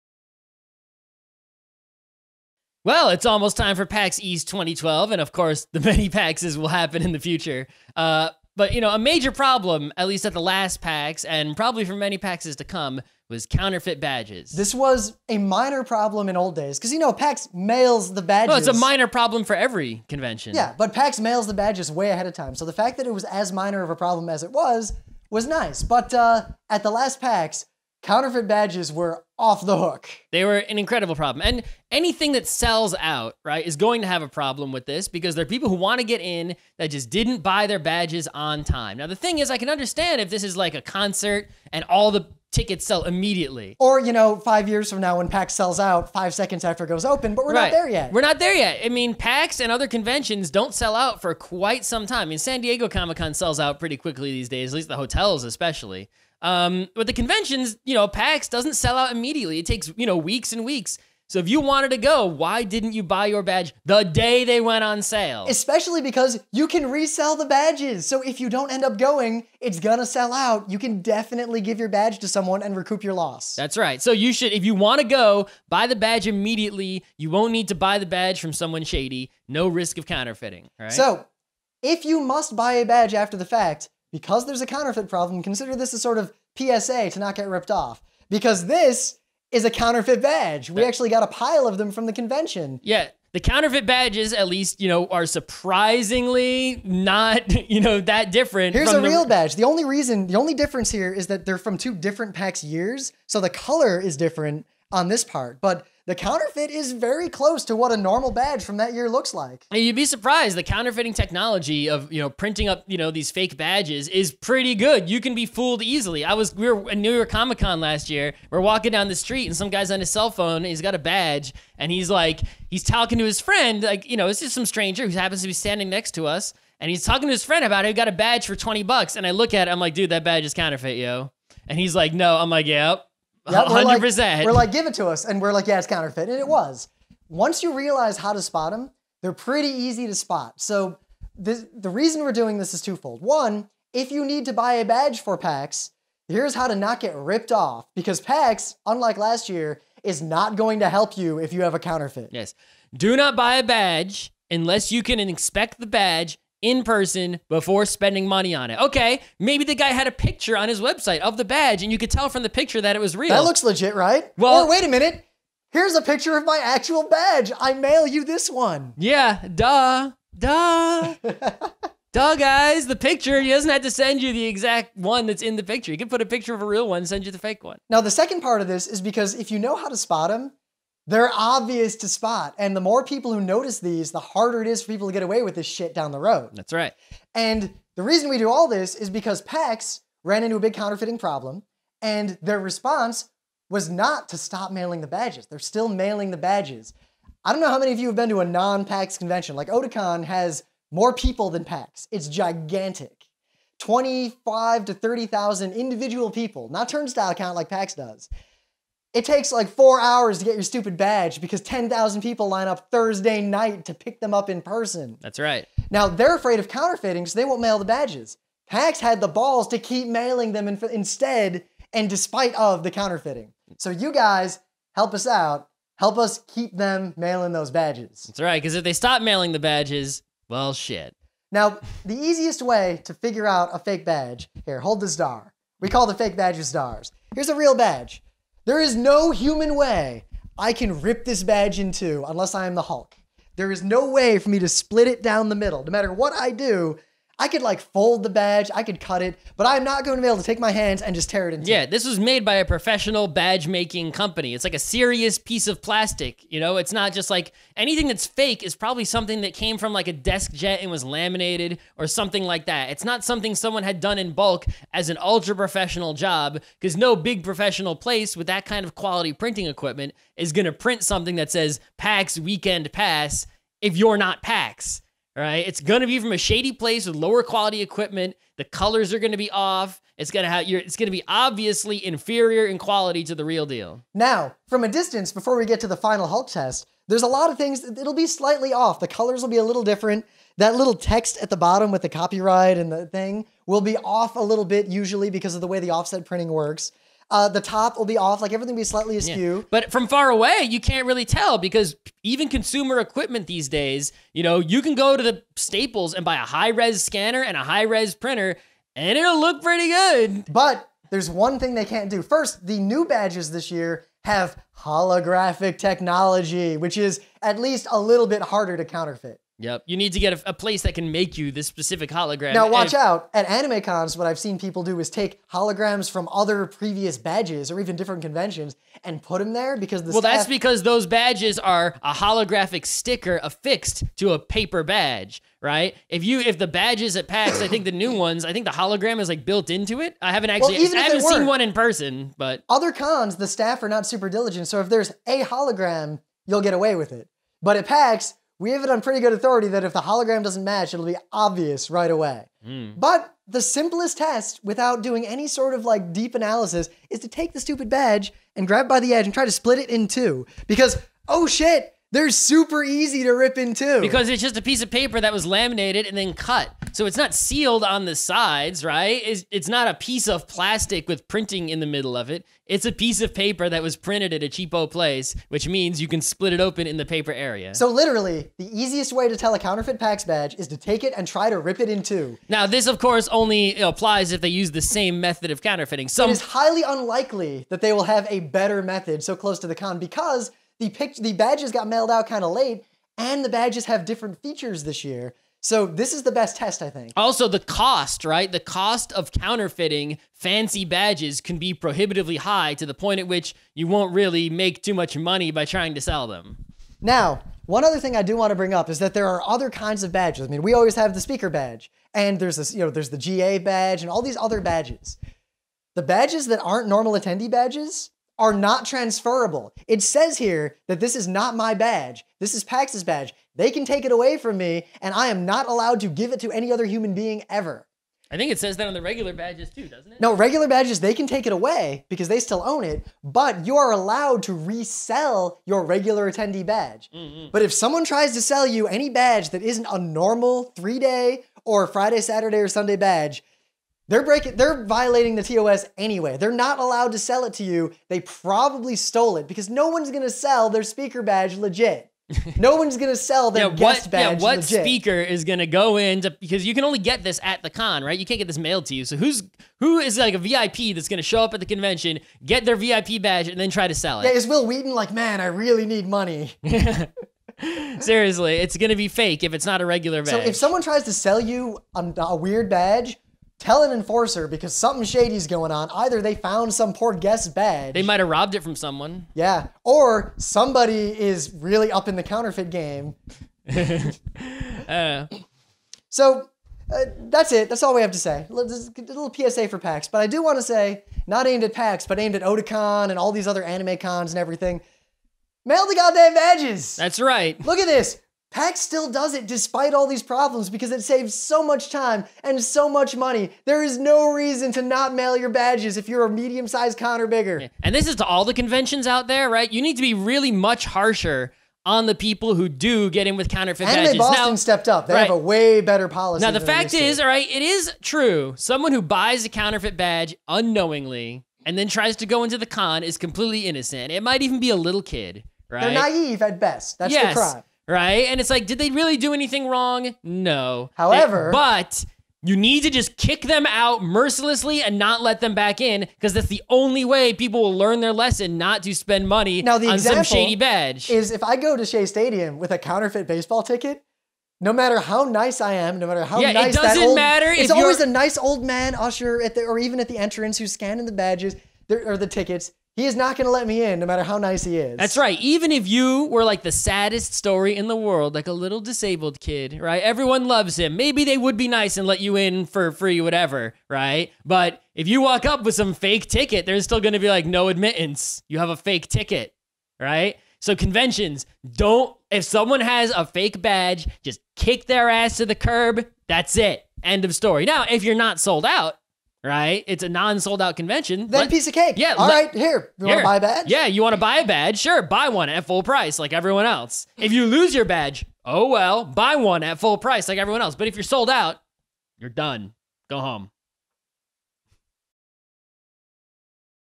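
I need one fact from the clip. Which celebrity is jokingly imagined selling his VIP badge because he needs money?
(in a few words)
Wil Wheaton.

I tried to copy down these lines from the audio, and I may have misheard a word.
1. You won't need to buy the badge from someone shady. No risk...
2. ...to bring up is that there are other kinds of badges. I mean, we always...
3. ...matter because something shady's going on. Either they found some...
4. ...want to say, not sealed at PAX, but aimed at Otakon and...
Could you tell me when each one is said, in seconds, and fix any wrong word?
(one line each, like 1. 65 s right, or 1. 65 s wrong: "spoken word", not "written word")
1. 77 s right
2. 408 s right
3. 473 s wrong: "enforcer", not "matter"
4. 490 s wrong: "aimed", not "sealed".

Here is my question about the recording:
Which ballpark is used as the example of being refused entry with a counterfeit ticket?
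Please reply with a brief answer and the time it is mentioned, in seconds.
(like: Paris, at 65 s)
Shea Stadium, at 541 s.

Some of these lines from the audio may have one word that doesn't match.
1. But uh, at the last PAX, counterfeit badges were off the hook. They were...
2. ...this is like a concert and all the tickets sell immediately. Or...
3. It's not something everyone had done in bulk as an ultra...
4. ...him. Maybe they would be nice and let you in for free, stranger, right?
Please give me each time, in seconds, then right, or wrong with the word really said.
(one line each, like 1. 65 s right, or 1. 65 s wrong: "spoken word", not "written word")
1. 25 s right
2. 40 s right
3. 262 s wrong: "someone", not "everyone"
4. 560 s wrong: "whatever", not "stranger".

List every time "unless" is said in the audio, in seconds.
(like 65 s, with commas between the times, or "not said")
154 s, 242 s.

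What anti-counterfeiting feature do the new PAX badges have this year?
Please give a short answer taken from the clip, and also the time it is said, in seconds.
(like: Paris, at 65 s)
holographic technology, at 314 s.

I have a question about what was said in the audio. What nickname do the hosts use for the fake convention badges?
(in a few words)
stars.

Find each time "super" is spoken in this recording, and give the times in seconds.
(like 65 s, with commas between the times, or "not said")
344 s, 362 s.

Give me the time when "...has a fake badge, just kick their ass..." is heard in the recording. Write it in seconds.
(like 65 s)
572 s.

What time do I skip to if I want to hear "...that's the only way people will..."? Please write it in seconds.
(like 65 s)
536 s.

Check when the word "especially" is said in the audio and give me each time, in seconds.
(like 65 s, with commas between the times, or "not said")
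55 s, 65 s.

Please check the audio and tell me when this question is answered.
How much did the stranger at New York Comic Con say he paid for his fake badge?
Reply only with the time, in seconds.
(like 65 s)
128 s.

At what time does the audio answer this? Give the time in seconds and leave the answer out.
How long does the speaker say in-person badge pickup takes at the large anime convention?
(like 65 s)
209 s.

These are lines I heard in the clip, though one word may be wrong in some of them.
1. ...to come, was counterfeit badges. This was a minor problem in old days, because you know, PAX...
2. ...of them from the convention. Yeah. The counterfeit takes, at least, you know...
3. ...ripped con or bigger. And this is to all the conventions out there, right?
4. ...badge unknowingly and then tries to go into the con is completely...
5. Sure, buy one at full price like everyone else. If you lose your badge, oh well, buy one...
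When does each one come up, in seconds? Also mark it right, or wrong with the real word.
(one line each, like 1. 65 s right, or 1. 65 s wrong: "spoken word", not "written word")
1. 12 s right
2. 91 s wrong: "badges", not "takes"
3. 506 s wrong: "sized", not "ripped"
4. 519 s right
5. 584 s right.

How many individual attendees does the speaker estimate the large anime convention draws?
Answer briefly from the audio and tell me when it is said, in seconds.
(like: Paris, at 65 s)
25,000 to 30,000, at 203 s.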